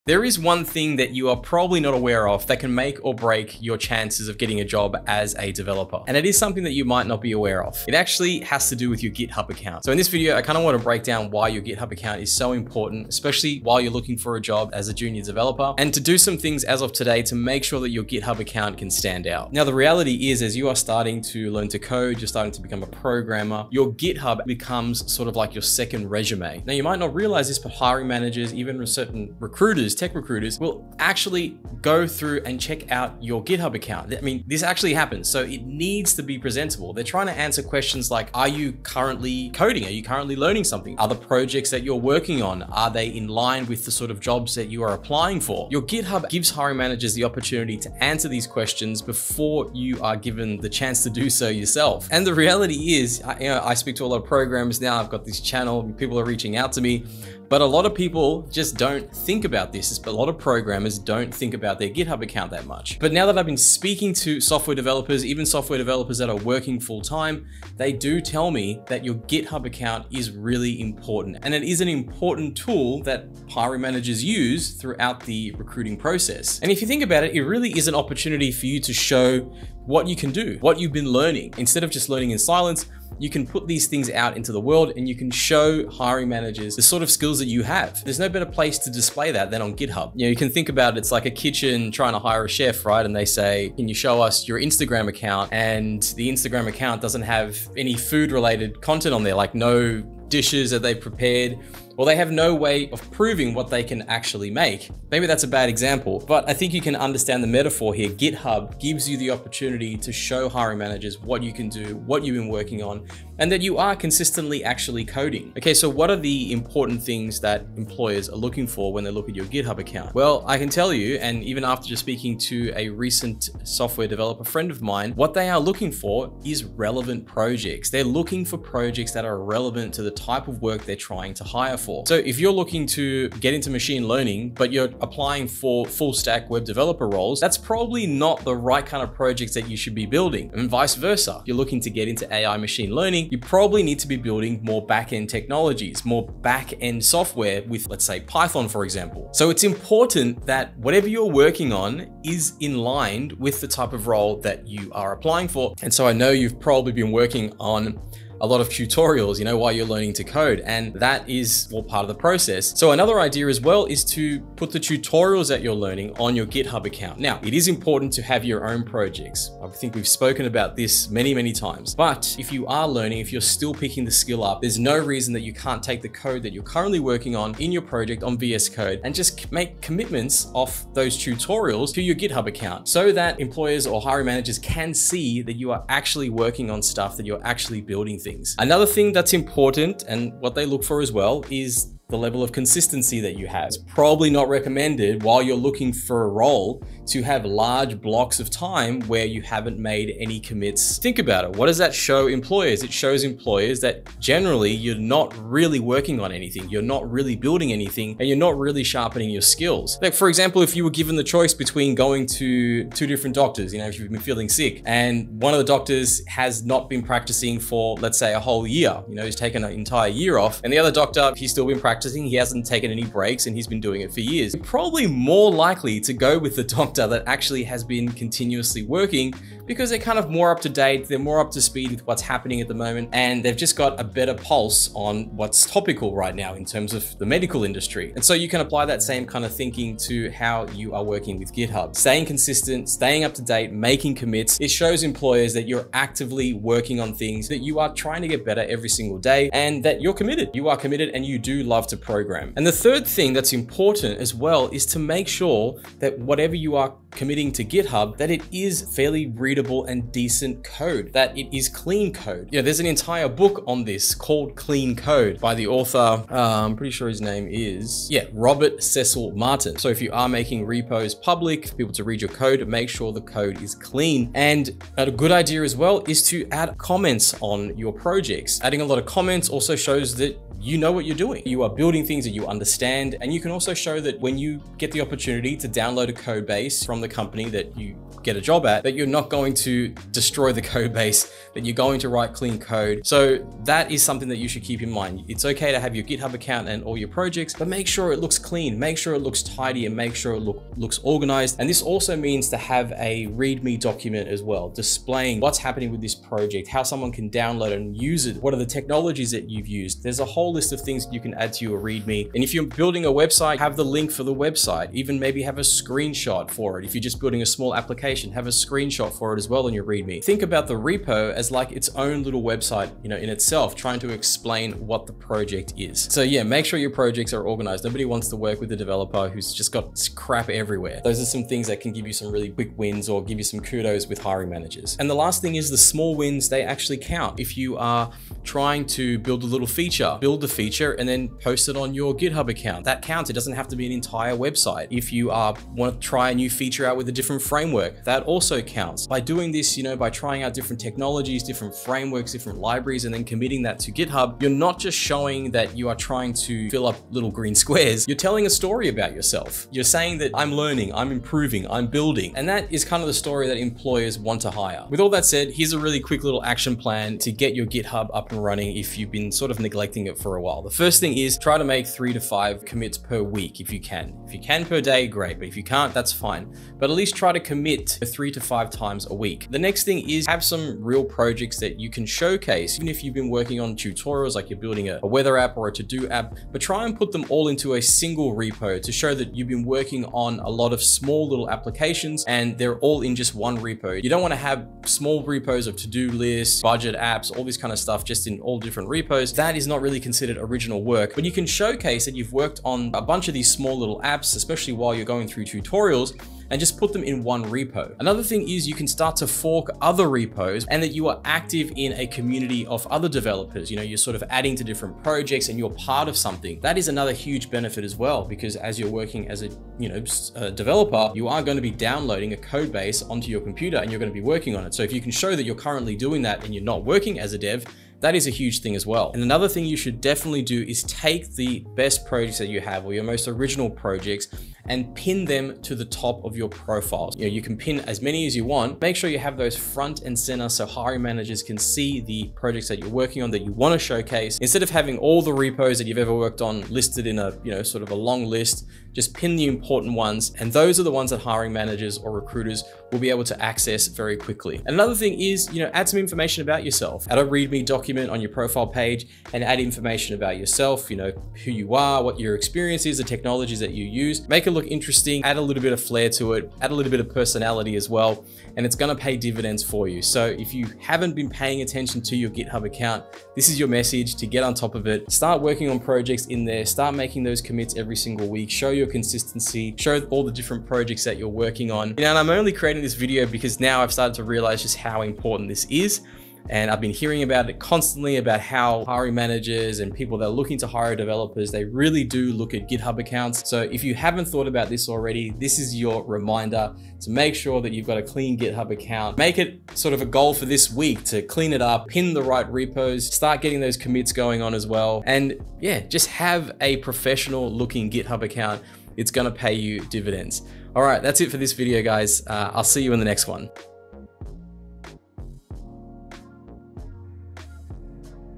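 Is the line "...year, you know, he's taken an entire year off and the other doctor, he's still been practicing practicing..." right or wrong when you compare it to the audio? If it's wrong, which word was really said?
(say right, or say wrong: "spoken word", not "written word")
right.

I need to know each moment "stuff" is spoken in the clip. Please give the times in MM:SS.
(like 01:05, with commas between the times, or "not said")
03:06, 06:37.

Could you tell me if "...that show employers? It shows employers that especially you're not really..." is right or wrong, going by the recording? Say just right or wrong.
wrong.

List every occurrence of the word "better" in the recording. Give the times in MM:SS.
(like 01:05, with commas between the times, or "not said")
01:28, 03:54, 04:08.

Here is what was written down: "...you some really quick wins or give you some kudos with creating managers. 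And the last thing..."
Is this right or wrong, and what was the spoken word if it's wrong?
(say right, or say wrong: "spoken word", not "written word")
wrong: "hiring", not "creating".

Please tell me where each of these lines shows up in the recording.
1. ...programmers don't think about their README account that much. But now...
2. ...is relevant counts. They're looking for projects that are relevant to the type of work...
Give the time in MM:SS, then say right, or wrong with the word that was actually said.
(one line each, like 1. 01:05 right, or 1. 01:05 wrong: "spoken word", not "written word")
1. 01:00 wrong: "GitHub", not "README"
2. 02:06 wrong: "projects", not "counts".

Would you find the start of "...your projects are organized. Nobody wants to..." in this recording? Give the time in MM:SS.
05:26.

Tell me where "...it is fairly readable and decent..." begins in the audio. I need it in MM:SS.
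04:18.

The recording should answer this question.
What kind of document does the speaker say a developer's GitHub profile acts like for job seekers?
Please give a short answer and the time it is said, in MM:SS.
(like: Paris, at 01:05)
second resume, at 00:25.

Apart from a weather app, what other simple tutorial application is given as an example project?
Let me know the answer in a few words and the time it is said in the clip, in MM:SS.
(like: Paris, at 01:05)
to-do app, at 06:25.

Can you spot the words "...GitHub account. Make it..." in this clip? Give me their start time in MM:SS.
08:18.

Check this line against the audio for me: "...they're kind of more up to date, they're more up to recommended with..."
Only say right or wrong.
wrong.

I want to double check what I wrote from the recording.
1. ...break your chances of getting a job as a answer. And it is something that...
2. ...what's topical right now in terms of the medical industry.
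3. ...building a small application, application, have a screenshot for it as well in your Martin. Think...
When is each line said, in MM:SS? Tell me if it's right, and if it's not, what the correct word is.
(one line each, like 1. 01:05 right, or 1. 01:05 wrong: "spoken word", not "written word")
1. 00:03 wrong: "developer", not "answer"
2. 03:55 right
3. 05:17 wrong: "README", not "Martin".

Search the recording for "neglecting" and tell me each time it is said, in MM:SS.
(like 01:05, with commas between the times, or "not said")
06:09.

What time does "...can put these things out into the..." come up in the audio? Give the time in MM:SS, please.
01:23.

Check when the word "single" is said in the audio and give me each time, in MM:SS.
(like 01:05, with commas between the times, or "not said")
04:08, 06:27, 07:57.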